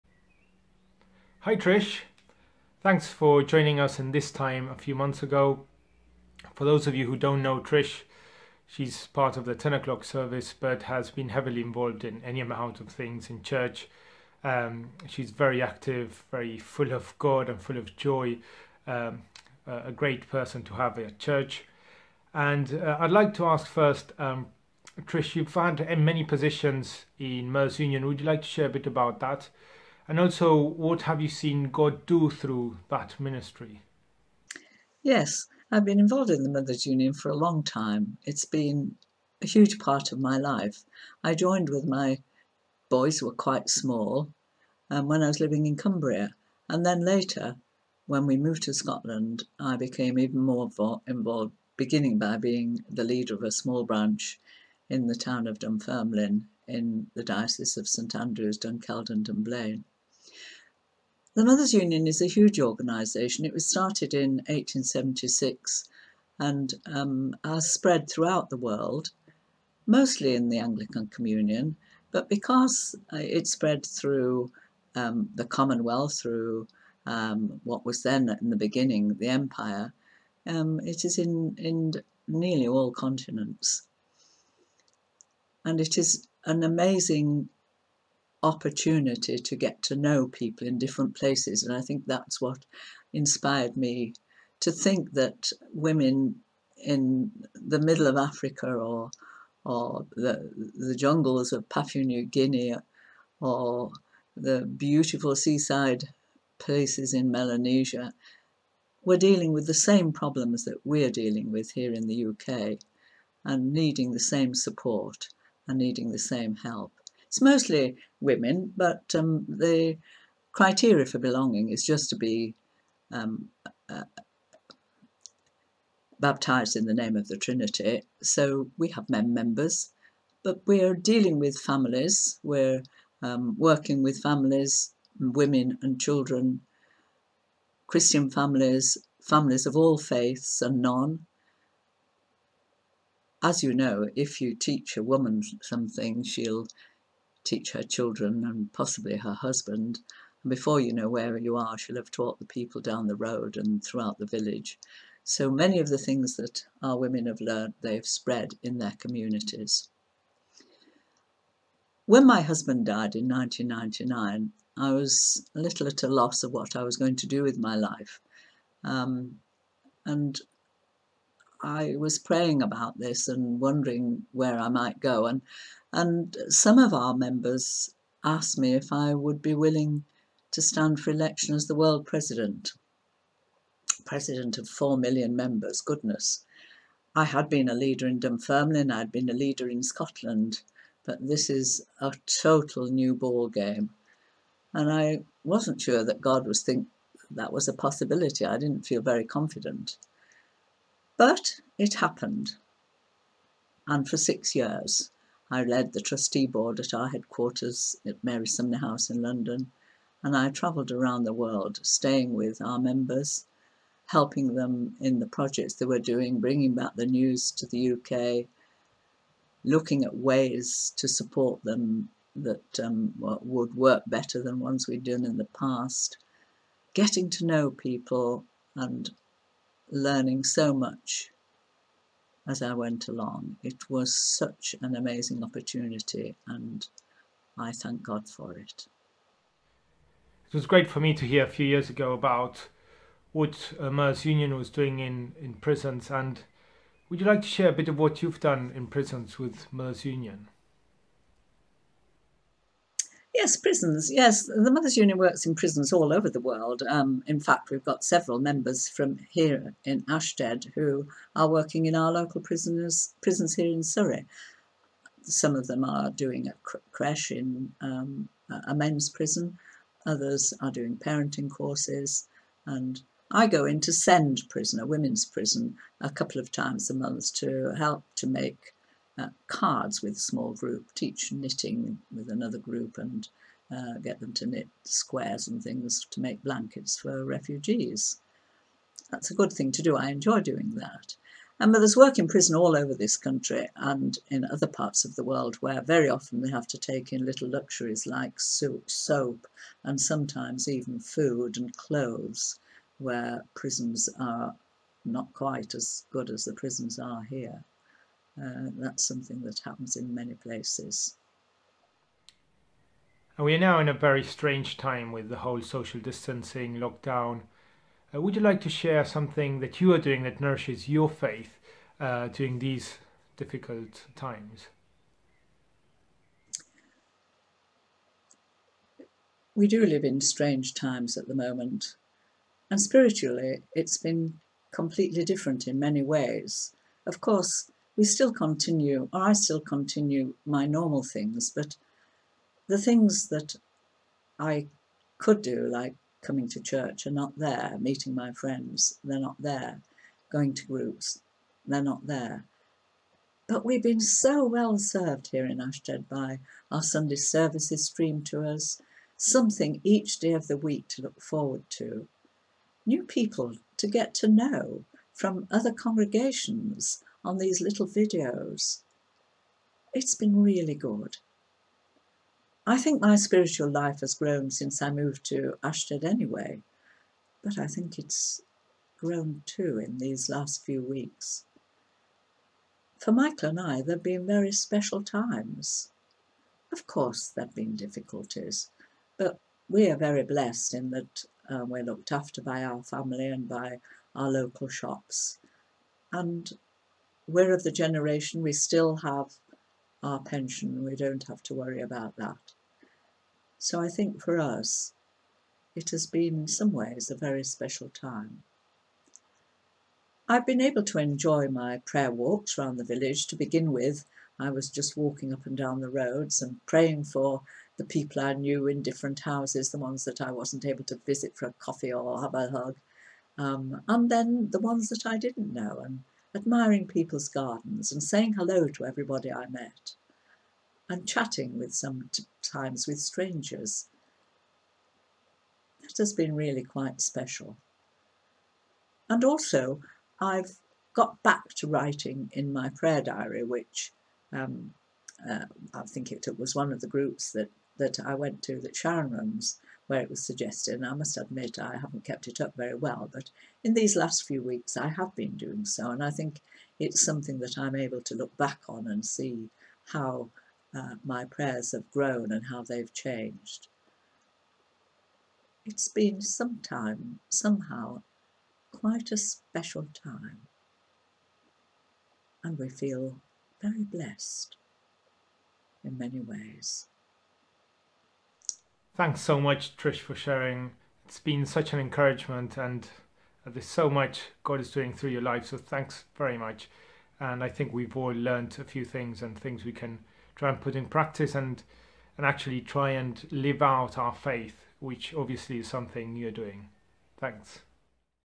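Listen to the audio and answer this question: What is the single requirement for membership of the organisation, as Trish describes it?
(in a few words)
baptized in the name of the Trinity.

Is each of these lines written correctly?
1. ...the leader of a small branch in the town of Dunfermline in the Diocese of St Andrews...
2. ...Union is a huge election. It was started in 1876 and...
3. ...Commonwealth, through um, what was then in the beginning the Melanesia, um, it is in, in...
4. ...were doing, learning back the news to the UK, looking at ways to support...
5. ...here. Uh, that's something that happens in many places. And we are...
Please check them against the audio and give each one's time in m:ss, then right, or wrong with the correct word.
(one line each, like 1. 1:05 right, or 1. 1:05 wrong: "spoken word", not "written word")
1. 0:52 right
2. 1:01 wrong: "organisation", not "election"
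3. 1:15 wrong: "Empire", not "Melanesia"
4. 3:35 wrong: "bringing", not "learning"
5. 5:07 right.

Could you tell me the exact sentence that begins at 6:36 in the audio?
And we're of the generation we still have our pension, we don't have to worry about that.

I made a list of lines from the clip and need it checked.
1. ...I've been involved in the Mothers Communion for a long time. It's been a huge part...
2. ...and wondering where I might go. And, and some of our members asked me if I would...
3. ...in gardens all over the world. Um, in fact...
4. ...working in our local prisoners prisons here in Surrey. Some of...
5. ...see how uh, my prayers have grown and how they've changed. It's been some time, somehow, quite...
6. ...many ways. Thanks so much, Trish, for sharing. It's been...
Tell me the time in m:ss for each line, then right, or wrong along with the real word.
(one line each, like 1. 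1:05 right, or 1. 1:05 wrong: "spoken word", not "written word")
1. 0:35 wrong: "Union", not "Communion"
2. 2:53 right
3. 4:15 wrong: "prisons", not "gardens"
4. 4:21 right
5. 7:39 right
6. 7:55 right.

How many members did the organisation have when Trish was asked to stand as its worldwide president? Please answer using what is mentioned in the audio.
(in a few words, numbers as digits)
4 million.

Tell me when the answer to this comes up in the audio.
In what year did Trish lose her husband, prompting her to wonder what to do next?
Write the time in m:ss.
2:43.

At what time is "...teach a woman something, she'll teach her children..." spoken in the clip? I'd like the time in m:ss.
2:24.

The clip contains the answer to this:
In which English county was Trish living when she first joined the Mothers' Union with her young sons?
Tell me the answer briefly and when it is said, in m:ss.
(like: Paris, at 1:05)
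Cumbria, at 0:45.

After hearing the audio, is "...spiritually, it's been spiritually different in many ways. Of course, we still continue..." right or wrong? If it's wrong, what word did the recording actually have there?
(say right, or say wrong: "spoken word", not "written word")
wrong: "completely", not "spiritually".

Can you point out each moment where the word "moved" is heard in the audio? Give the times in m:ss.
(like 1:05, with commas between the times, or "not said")
0:48, 6:14.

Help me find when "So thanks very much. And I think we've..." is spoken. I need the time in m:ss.
8:05.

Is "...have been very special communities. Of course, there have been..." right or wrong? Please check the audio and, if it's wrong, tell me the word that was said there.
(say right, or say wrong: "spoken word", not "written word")
wrong: "times", not "communities".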